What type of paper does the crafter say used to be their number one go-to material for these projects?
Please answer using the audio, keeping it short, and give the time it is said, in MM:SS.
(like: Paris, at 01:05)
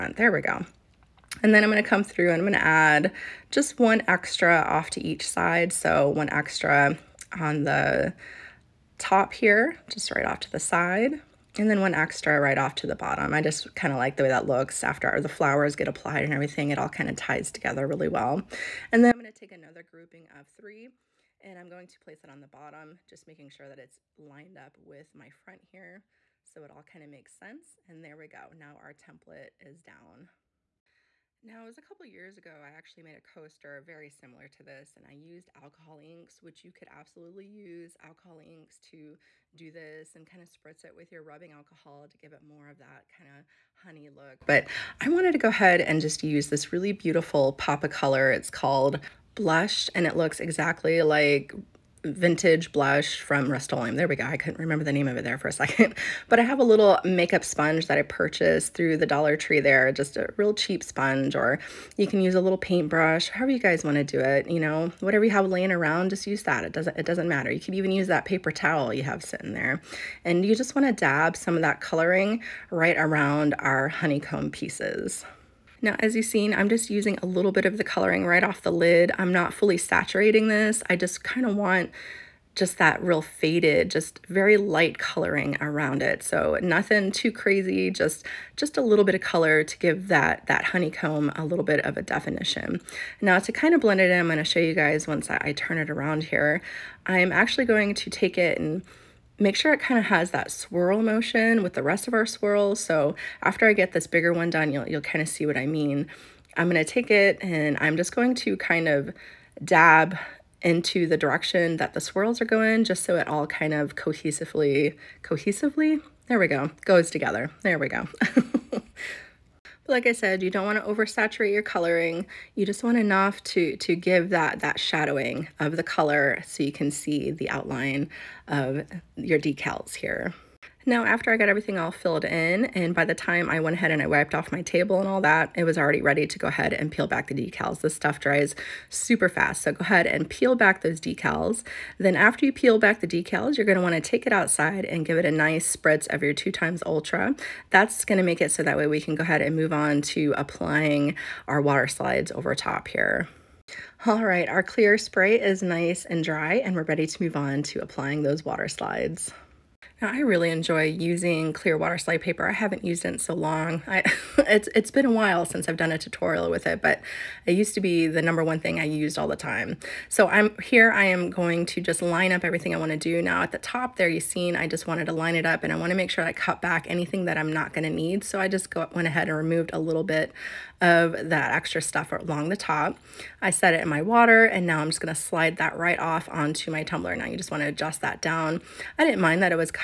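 Clear water slide paper, at 02:41.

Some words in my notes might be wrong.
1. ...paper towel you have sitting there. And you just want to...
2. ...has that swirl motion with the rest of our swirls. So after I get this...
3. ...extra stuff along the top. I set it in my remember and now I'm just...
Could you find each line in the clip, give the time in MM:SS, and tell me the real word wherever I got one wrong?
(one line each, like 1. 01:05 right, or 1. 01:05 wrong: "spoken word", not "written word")
1. 01:08 right
2. 01:40 right
3. 03:01 wrong: "water", not "remember".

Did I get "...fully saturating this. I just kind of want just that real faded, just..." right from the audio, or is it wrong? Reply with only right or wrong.
right.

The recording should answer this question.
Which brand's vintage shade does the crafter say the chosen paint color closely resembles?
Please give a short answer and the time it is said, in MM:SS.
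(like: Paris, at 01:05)
Rust-Oleum, at 00:53.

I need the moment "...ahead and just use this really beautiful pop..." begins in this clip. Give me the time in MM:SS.
00:45.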